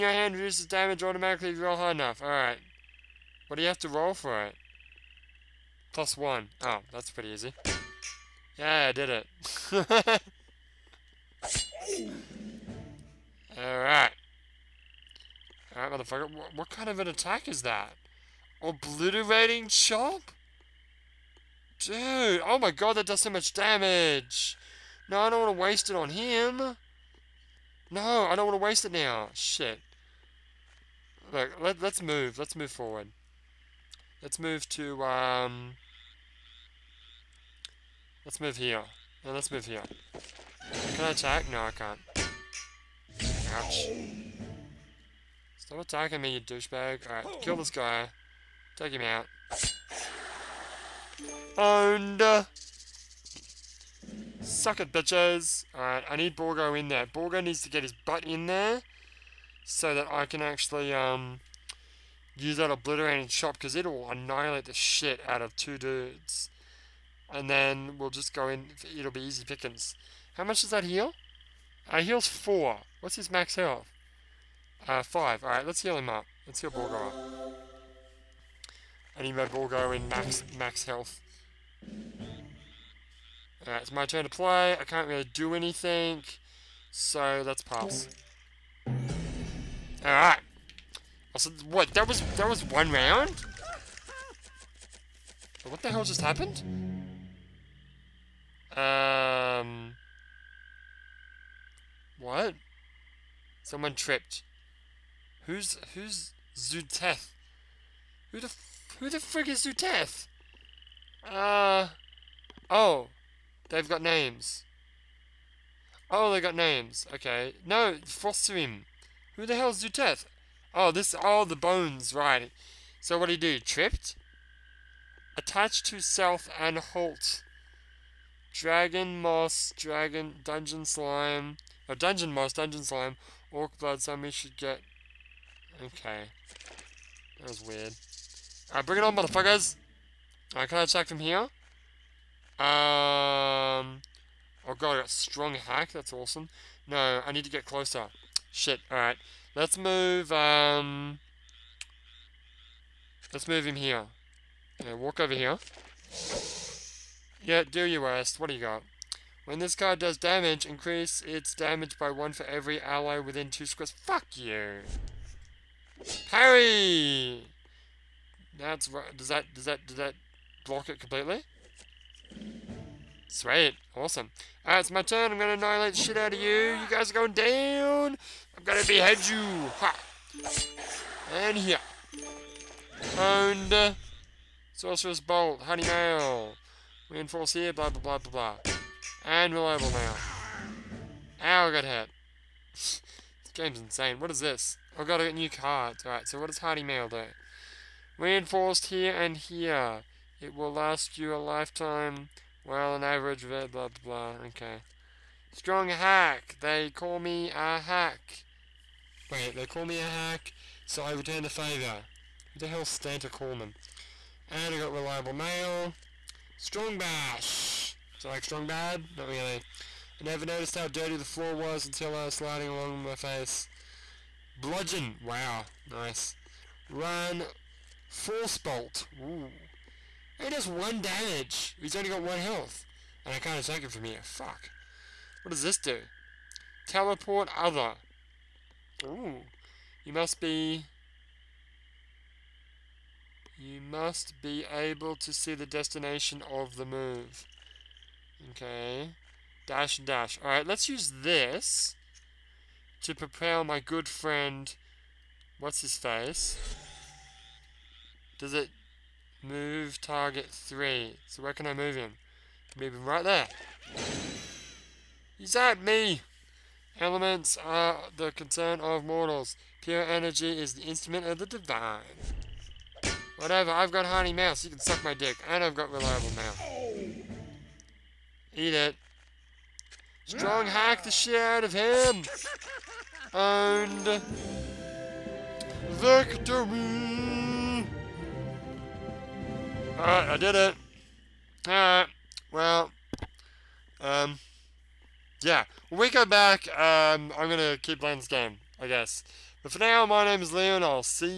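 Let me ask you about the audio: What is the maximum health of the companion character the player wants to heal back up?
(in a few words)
5.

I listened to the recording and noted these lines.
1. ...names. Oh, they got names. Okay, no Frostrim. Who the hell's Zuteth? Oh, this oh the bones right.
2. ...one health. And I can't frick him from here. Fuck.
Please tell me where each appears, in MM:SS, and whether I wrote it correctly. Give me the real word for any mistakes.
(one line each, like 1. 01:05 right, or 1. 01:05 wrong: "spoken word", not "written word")
1. 01:54 right
2. 03:52 wrong: "attack", not "frick".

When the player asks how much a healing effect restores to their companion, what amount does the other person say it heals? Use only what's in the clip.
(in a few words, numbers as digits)
4.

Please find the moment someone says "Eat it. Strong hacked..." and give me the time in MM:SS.
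04:38.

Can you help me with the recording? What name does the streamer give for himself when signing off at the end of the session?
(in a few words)
Leo.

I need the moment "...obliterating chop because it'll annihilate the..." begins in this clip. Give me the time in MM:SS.
01:02.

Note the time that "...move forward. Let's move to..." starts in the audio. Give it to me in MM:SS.
00:32.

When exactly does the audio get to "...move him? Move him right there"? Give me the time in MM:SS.
04:21.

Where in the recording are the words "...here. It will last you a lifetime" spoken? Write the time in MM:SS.
03:19.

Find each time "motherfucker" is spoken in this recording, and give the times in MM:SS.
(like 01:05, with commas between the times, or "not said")
00:15, 02:19.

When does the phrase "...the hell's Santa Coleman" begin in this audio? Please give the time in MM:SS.
03:32.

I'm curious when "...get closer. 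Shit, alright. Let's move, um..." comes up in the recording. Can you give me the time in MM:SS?
02:27.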